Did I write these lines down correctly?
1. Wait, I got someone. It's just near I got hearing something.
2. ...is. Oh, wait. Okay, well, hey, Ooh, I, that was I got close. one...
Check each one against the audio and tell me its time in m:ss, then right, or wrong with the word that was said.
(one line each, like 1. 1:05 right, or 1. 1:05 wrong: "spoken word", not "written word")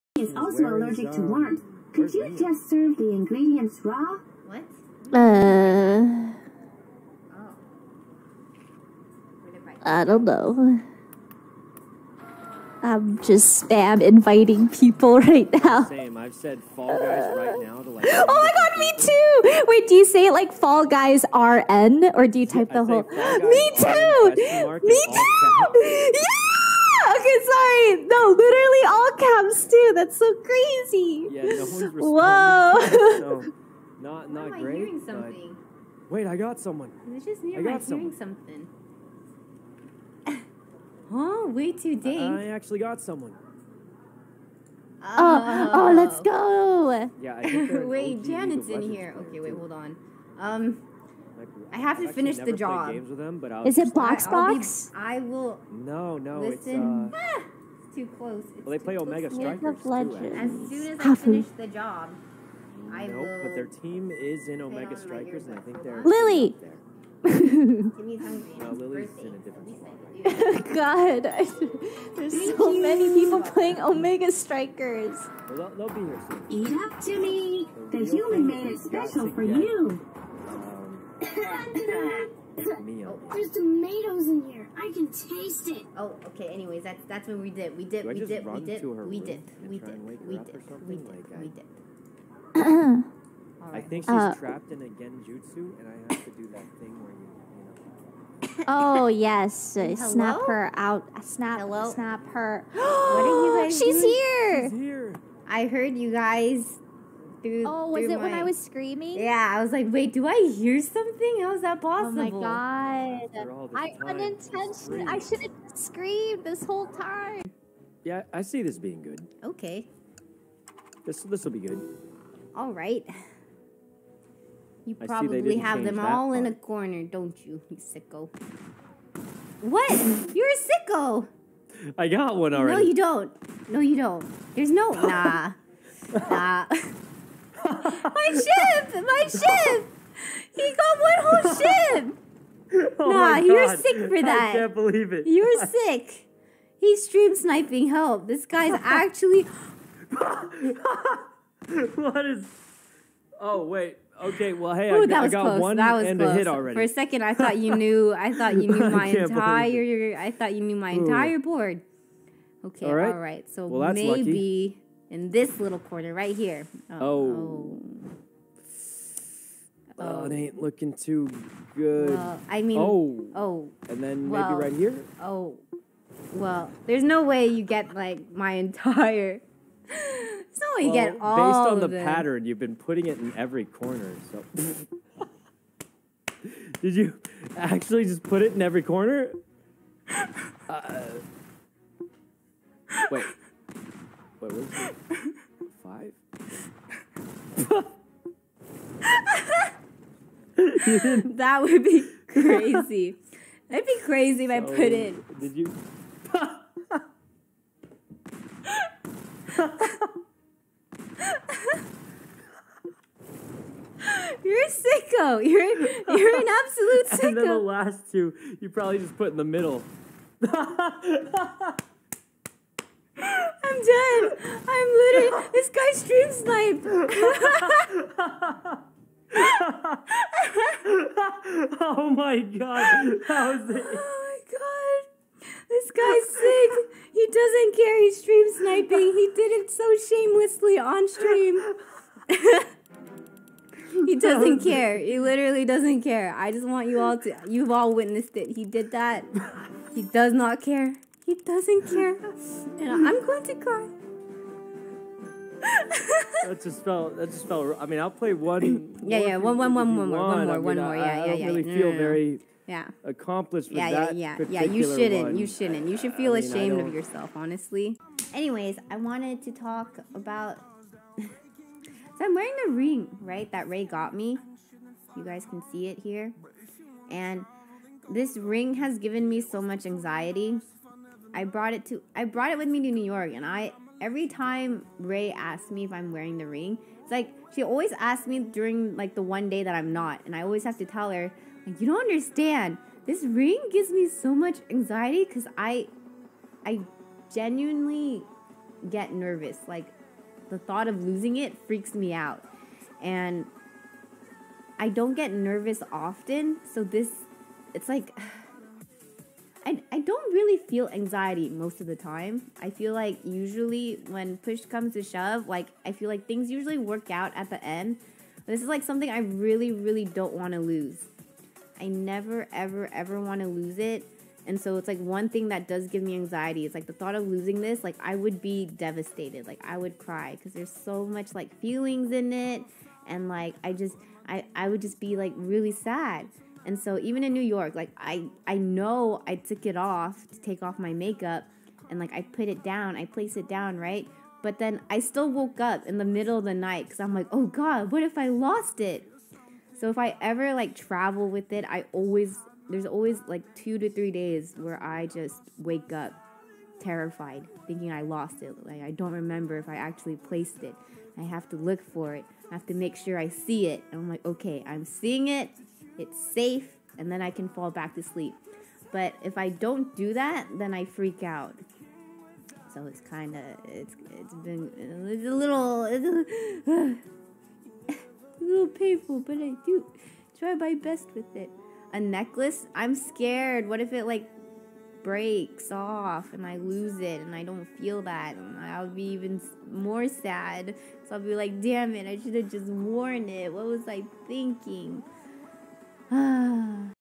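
1. 0:36 right
2. 2:32 right.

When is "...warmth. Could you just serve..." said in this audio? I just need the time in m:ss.
0:01.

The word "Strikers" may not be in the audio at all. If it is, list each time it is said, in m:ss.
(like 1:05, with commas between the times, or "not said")
0:59, 1:04, 1:14.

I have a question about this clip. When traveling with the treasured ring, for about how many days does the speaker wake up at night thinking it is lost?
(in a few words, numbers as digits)
2 to 3 days.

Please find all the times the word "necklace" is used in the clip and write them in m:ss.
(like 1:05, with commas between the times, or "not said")
6:21.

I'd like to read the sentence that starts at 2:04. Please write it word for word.
You probably have them all part.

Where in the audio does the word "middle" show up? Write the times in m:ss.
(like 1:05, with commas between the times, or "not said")
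3:39, 5:46.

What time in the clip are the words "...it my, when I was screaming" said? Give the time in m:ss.
1:48.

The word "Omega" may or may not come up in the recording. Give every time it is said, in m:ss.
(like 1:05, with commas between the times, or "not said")
0:58, 1:04, 1:13.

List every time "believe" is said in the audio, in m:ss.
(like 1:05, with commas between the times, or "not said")
2:24.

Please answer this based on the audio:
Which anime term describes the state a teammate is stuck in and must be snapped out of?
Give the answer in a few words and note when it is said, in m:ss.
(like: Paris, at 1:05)
Genjutsu, at 1:34.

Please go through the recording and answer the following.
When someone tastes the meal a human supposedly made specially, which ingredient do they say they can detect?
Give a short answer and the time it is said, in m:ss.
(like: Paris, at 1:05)
Tomatoes, at 1:23.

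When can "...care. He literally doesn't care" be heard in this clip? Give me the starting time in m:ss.
4:04.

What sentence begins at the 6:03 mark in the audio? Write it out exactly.
And I'm like, "Okay, I'm seeing it." it's safe, and then I can fall back to sleep.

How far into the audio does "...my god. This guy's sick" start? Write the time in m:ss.
3:54.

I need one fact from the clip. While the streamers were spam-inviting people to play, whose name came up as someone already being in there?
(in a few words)
Janet.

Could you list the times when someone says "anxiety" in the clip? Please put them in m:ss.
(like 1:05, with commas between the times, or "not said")
4:39, 4:54, 5:10, 5:26.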